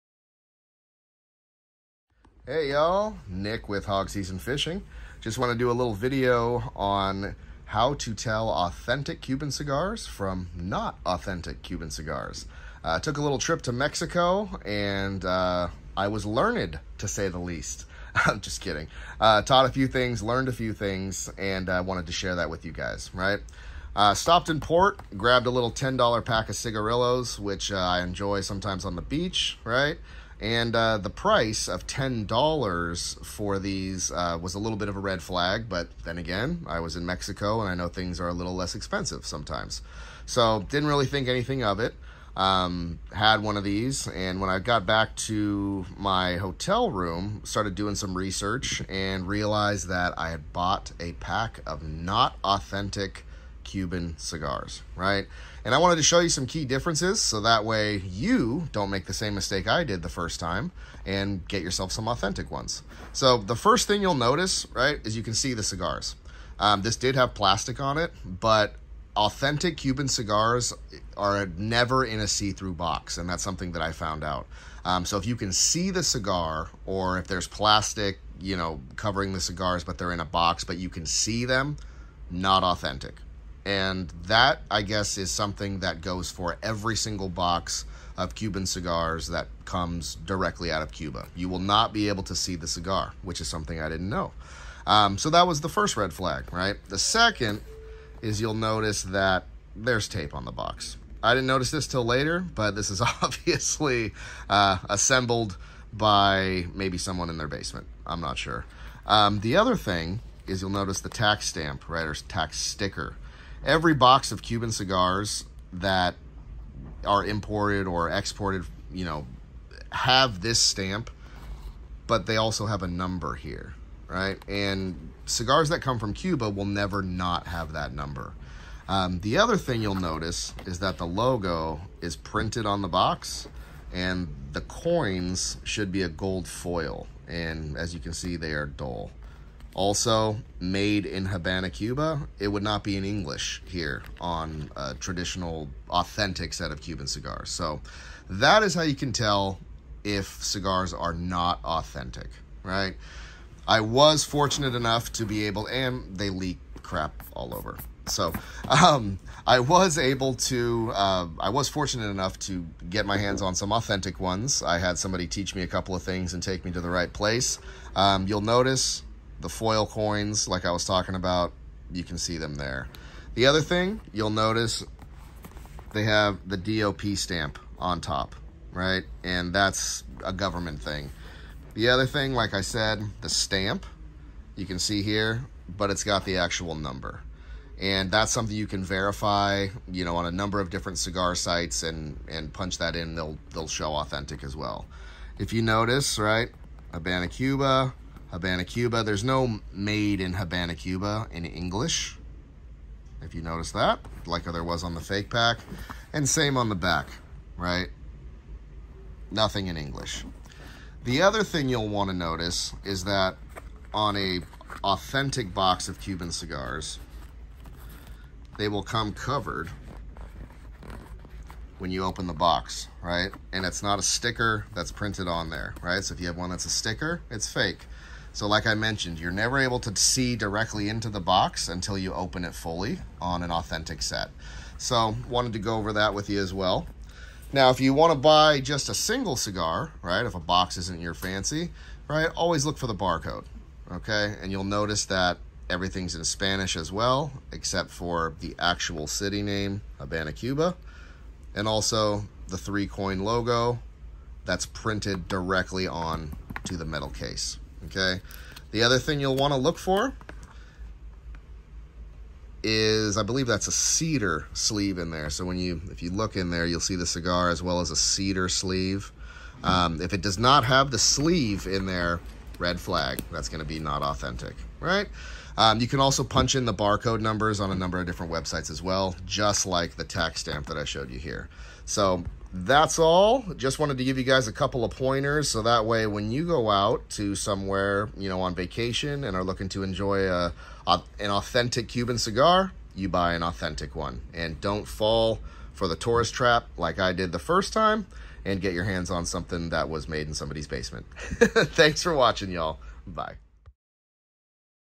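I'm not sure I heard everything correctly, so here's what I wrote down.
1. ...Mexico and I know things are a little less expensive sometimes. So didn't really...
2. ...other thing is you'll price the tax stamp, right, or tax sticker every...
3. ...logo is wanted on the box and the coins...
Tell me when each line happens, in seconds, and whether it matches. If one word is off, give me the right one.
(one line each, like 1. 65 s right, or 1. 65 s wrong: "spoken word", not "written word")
1. 37 s right
2. 109 s wrong: "notice", not "price"
3. 131 s wrong: "printed", not "wanted".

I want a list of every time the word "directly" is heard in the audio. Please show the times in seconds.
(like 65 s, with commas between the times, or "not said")
90 s, 230 s, 255 s.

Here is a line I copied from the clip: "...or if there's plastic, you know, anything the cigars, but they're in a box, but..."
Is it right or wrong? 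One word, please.
wrong.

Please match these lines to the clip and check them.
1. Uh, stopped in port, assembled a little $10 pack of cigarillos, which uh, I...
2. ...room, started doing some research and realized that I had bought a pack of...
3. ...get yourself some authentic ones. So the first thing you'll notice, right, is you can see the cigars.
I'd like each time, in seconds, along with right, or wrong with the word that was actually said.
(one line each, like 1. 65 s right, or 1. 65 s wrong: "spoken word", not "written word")
1. 23 s wrong: "grabbed", not "assembled"
2. 46 s right
3. 61 s right.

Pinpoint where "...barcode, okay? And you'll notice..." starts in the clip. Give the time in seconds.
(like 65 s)
242 s.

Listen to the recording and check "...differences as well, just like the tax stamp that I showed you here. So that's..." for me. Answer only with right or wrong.
wrong.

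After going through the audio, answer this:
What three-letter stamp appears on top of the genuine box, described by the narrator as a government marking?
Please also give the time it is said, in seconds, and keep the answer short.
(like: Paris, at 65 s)
DOP, at 176 s.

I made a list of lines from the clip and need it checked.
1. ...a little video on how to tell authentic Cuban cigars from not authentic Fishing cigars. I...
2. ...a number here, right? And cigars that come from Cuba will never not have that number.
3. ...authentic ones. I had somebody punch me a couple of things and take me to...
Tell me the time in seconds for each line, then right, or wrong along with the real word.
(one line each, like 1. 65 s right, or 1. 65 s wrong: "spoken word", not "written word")
1. 5 s wrong: "Cuban", not "Fishing"
2. 122 s right
3. 163 s wrong: "teach", not "punch".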